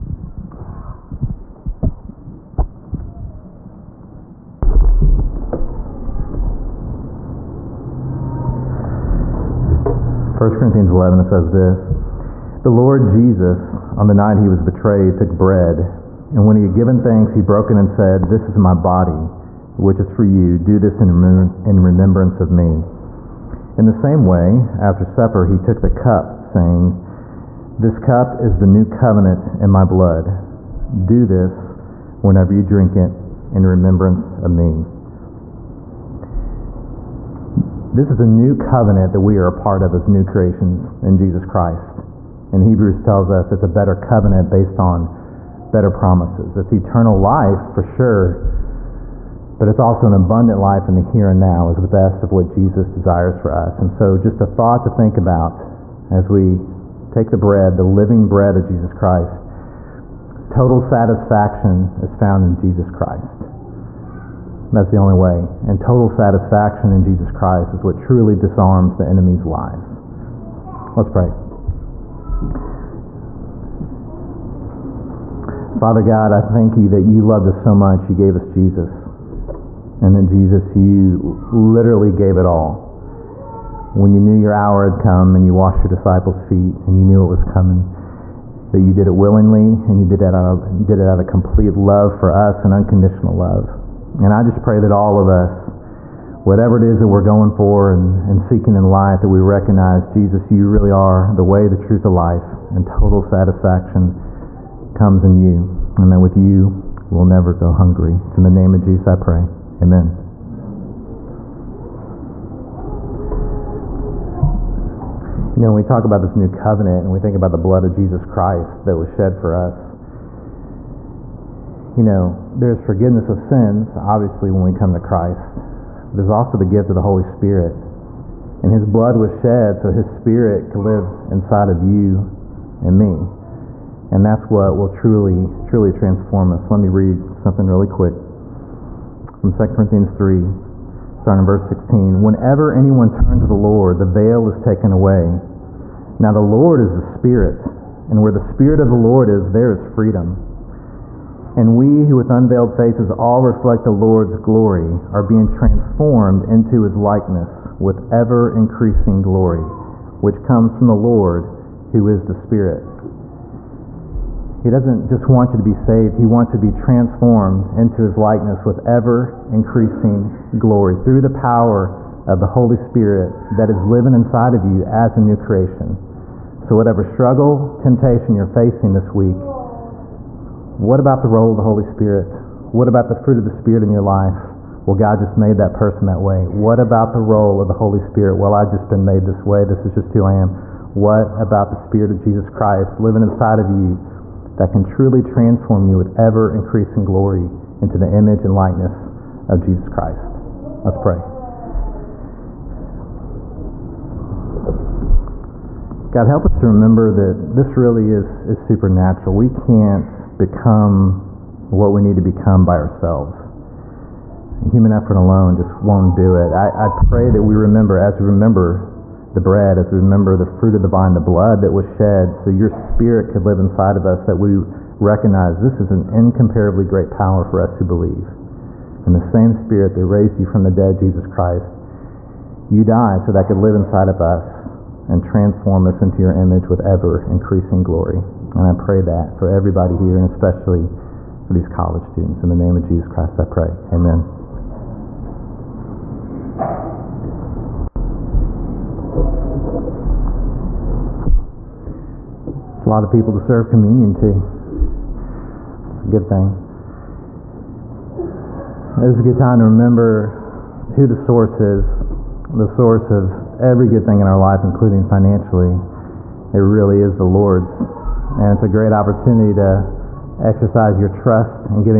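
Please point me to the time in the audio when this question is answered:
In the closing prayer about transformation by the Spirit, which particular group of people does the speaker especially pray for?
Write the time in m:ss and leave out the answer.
4:01.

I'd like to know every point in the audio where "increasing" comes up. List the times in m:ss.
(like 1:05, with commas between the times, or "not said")
2:38, 2:49, 3:16, 3:57.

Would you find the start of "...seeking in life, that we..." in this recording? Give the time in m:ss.
1:38.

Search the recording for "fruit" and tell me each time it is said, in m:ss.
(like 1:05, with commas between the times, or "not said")
3:03, 3:40.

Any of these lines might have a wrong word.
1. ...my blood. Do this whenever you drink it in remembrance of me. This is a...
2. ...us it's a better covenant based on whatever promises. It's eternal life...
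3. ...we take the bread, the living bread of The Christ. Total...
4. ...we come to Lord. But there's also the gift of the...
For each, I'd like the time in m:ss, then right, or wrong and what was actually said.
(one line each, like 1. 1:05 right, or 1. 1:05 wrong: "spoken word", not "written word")
1. 0:29 right
2. 0:43 wrong: "better", not "whatever"
3. 0:56 wrong: "Jesus", not "The"
4. 2:04 wrong: "Christ", not "Lord".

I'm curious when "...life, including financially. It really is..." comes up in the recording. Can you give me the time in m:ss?
4:24.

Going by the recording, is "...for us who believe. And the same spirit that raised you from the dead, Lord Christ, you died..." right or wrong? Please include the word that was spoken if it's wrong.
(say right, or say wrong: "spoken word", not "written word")
wrong: "Jesus", not "Lord".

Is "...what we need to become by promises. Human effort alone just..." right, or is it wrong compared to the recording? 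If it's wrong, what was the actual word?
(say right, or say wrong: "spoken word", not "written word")
wrong: "ourselves", not "promises".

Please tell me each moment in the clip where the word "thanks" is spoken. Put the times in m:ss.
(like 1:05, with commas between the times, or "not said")
0:17, 1:16.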